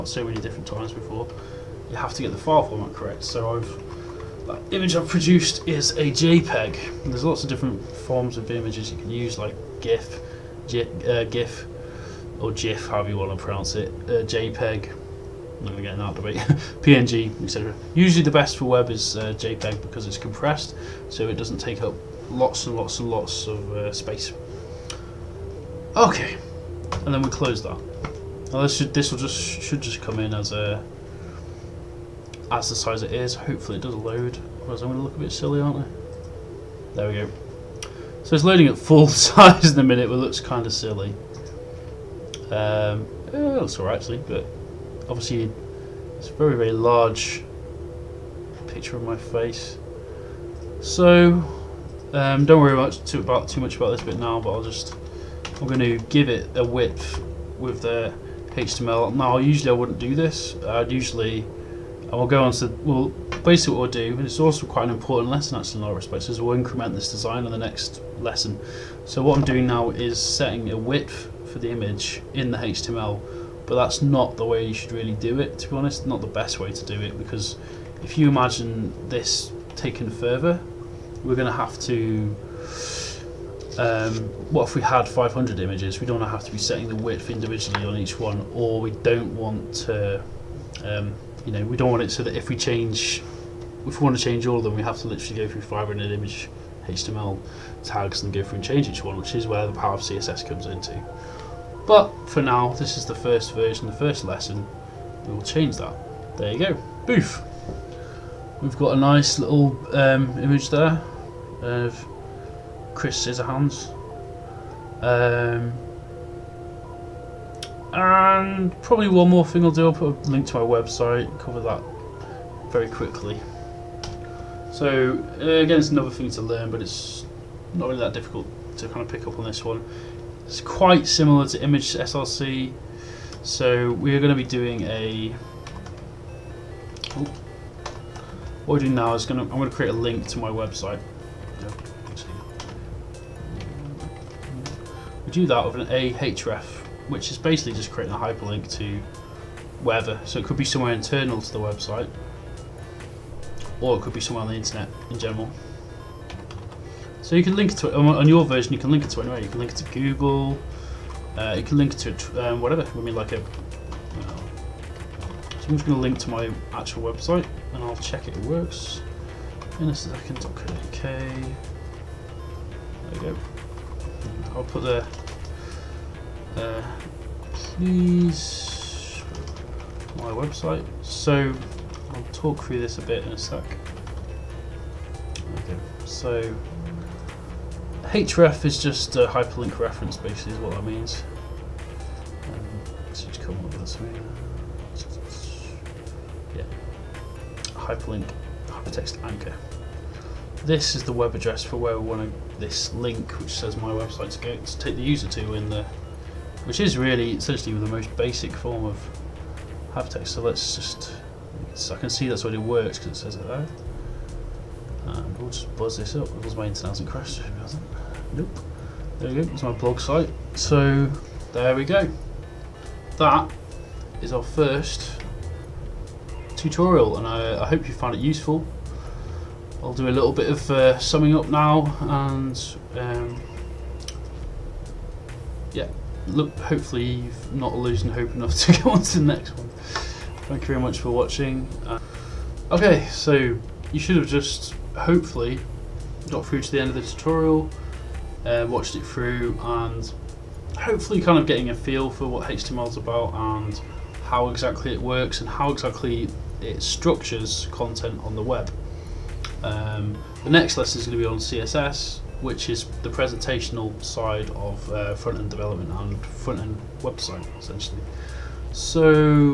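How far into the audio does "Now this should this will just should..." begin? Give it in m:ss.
0:28.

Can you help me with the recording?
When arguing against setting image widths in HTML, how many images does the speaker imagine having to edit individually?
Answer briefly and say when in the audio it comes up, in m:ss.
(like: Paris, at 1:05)
500, at 1:25.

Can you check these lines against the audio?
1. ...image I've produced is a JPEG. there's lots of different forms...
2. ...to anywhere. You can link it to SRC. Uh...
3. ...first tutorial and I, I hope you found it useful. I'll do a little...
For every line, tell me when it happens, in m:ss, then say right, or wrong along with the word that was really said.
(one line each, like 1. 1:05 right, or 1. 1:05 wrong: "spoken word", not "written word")
1. 0:04 right
2. 2:39 wrong: "Google", not "SRC"
3. 3:44 right.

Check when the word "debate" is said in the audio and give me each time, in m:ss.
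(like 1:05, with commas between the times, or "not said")
0:16.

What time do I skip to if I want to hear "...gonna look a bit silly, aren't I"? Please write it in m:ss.
0:34.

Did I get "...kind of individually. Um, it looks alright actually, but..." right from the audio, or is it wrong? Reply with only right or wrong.
wrong.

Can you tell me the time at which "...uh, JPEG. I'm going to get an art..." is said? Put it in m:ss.
0:14.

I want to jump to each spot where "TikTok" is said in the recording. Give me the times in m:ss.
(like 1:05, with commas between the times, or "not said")
not said.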